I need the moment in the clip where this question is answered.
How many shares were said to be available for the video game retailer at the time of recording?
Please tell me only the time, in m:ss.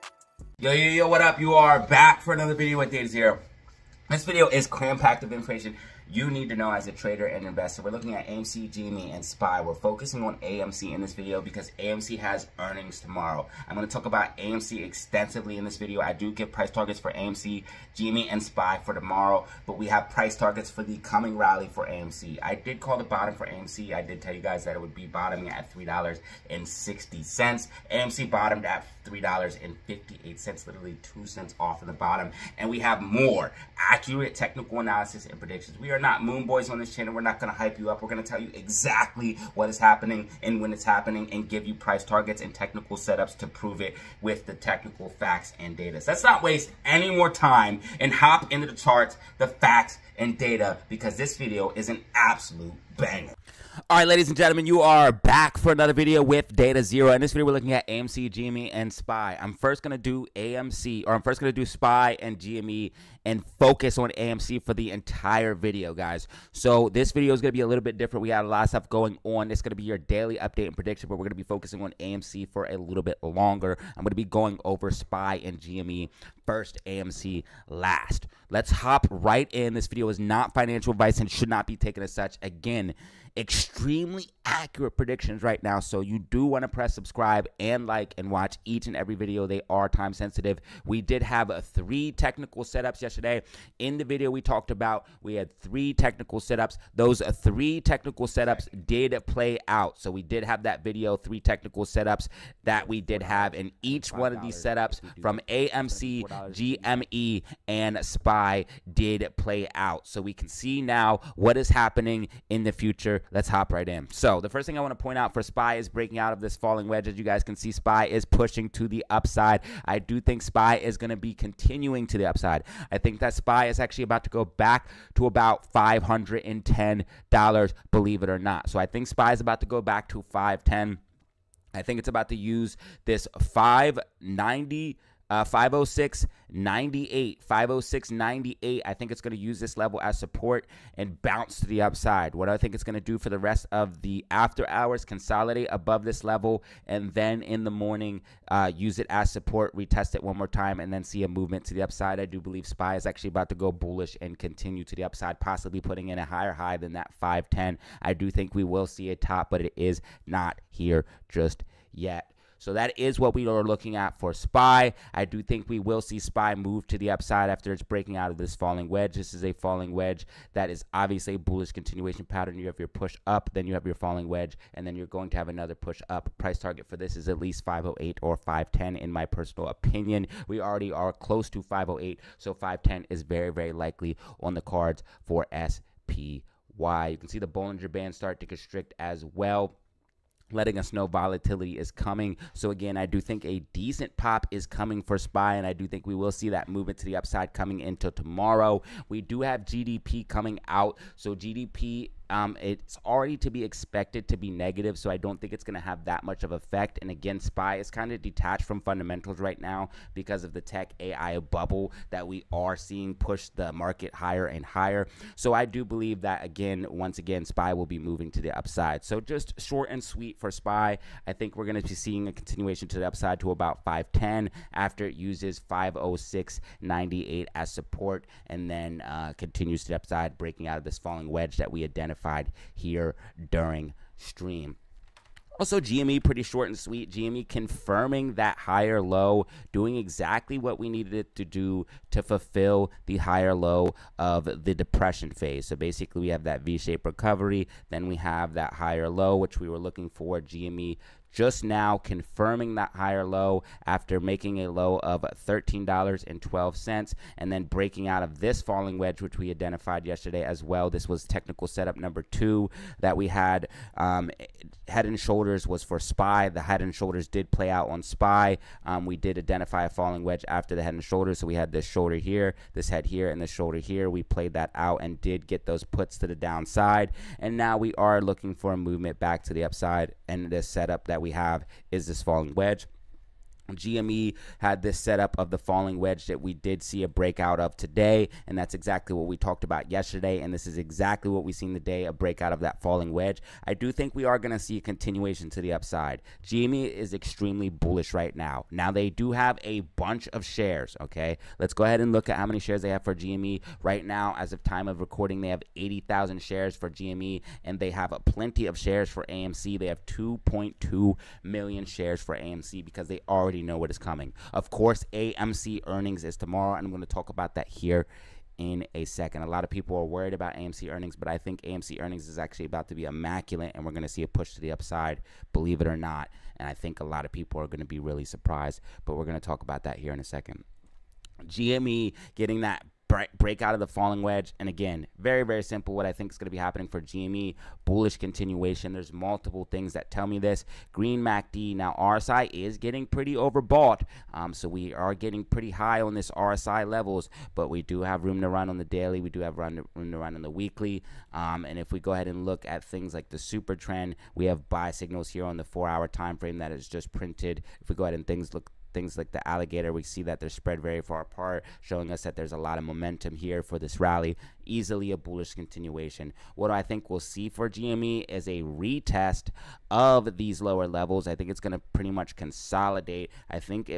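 5:05.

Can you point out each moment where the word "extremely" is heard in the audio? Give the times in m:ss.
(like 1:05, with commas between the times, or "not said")
1:23, 4:57.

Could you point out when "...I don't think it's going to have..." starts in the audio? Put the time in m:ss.
3:25.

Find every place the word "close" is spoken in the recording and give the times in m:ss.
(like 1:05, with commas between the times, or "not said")
3:01.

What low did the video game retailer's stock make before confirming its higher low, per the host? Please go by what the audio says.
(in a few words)
$13.12.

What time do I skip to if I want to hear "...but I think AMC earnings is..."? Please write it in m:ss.
5:21.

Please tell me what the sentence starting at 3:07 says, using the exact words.
You can see the Bollinger Band start to constrict as well letting us know volatility is coming.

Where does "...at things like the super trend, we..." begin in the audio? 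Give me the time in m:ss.
5:52.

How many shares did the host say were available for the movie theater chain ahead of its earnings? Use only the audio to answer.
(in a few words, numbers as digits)
2.2 million.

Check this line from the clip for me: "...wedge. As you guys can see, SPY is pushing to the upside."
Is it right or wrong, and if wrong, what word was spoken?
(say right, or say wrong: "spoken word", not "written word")
right.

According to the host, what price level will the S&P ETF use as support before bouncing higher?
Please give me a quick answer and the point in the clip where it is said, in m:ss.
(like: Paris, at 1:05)
506.98, at 3:45.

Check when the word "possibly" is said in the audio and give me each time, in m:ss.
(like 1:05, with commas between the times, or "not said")
2:35.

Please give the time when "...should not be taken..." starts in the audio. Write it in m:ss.
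1:21.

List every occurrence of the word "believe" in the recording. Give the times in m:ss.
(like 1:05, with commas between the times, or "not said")
2:07, 2:32, 3:35, 5:25.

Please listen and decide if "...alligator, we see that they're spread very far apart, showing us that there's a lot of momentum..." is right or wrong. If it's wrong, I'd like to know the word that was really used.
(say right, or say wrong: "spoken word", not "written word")
right.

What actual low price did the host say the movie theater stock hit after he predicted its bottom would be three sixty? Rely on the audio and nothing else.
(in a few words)
$3.58.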